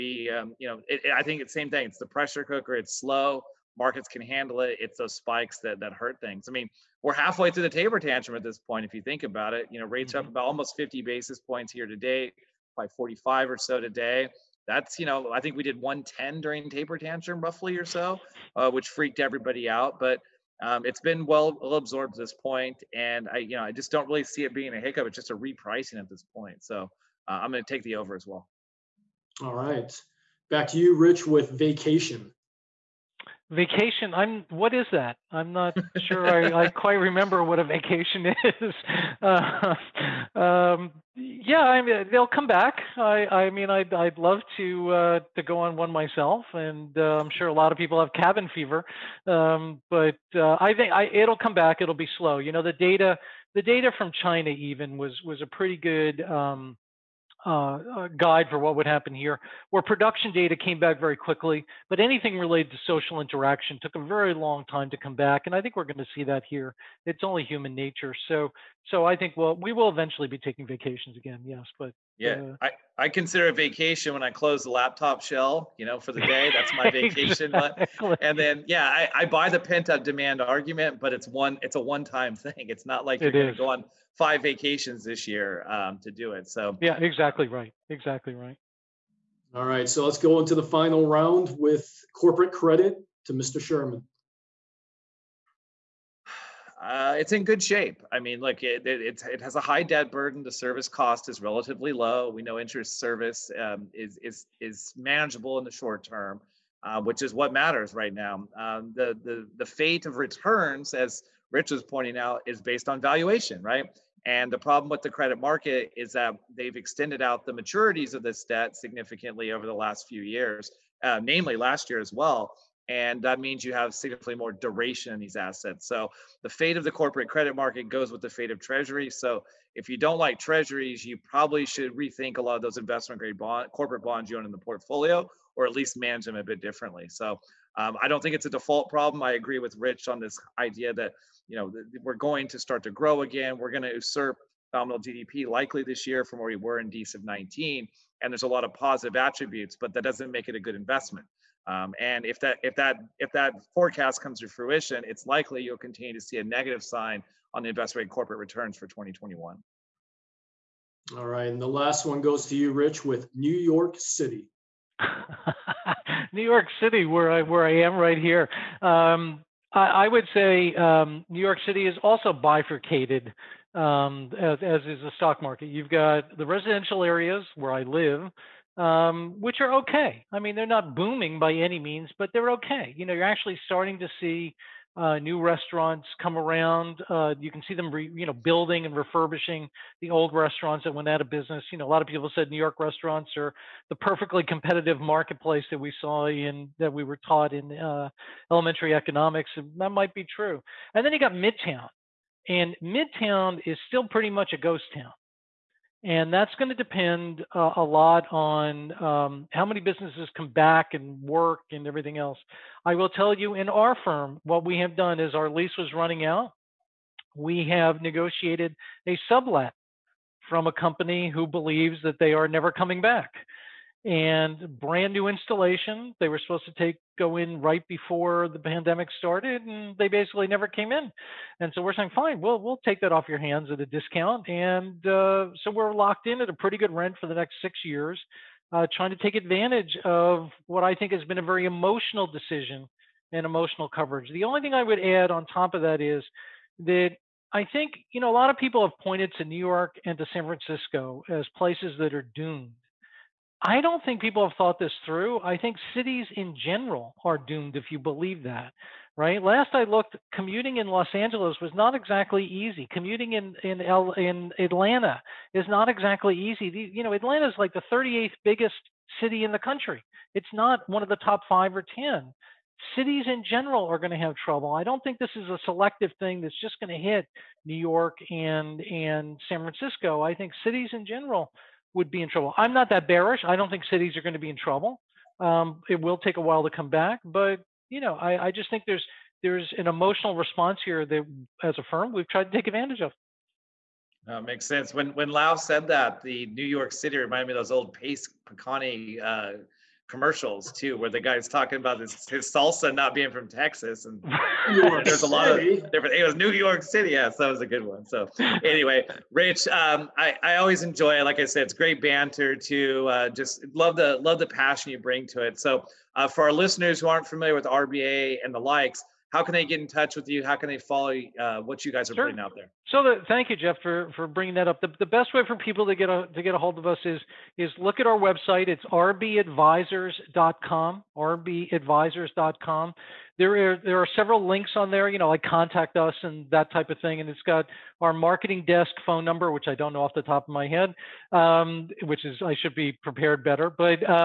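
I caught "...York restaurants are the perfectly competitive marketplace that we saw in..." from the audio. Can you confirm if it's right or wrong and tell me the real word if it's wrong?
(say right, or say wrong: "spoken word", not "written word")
right.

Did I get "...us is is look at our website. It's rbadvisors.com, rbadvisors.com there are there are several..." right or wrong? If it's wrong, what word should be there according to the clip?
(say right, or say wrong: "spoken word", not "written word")
right.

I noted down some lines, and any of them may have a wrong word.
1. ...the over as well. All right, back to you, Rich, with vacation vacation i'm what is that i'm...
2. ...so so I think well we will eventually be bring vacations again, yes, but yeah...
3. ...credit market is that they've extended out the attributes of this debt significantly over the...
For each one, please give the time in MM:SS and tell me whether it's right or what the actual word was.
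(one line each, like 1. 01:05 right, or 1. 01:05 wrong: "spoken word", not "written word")
1. 00:27 right
2. 01:08 wrong: "taking", not "bring"
3. 01:55 wrong: "maturities", not "attributes".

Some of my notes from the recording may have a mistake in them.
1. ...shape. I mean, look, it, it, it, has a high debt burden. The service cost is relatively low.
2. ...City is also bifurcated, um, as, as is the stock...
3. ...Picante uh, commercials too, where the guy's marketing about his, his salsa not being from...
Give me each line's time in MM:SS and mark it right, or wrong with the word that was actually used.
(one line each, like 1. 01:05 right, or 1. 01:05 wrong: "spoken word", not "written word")
1. 01:37 right
2. 02:51 right
3. 04:58 wrong: "talking", not "marketing".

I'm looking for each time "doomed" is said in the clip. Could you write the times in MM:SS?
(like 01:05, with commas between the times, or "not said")
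04:12, 04:17.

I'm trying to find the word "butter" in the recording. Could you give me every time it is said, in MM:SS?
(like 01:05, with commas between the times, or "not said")
not said.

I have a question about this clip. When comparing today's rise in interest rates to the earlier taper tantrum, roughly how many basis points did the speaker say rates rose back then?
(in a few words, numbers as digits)
110.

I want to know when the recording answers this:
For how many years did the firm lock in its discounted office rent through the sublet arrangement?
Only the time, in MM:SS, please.
03:57.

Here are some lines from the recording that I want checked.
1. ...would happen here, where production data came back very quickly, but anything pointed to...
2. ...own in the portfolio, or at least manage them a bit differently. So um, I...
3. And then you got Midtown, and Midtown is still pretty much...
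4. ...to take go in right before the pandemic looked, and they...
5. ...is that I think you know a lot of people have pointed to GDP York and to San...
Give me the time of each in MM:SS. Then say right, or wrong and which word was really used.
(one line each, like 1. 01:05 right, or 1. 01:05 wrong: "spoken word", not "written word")
1. 00:58 wrong: "related", not "pointed"
2. 02:14 right
3. 03:20 right
4. 03:46 wrong: "started", not "looked"
5. 04:06 wrong: "New", not "GDP".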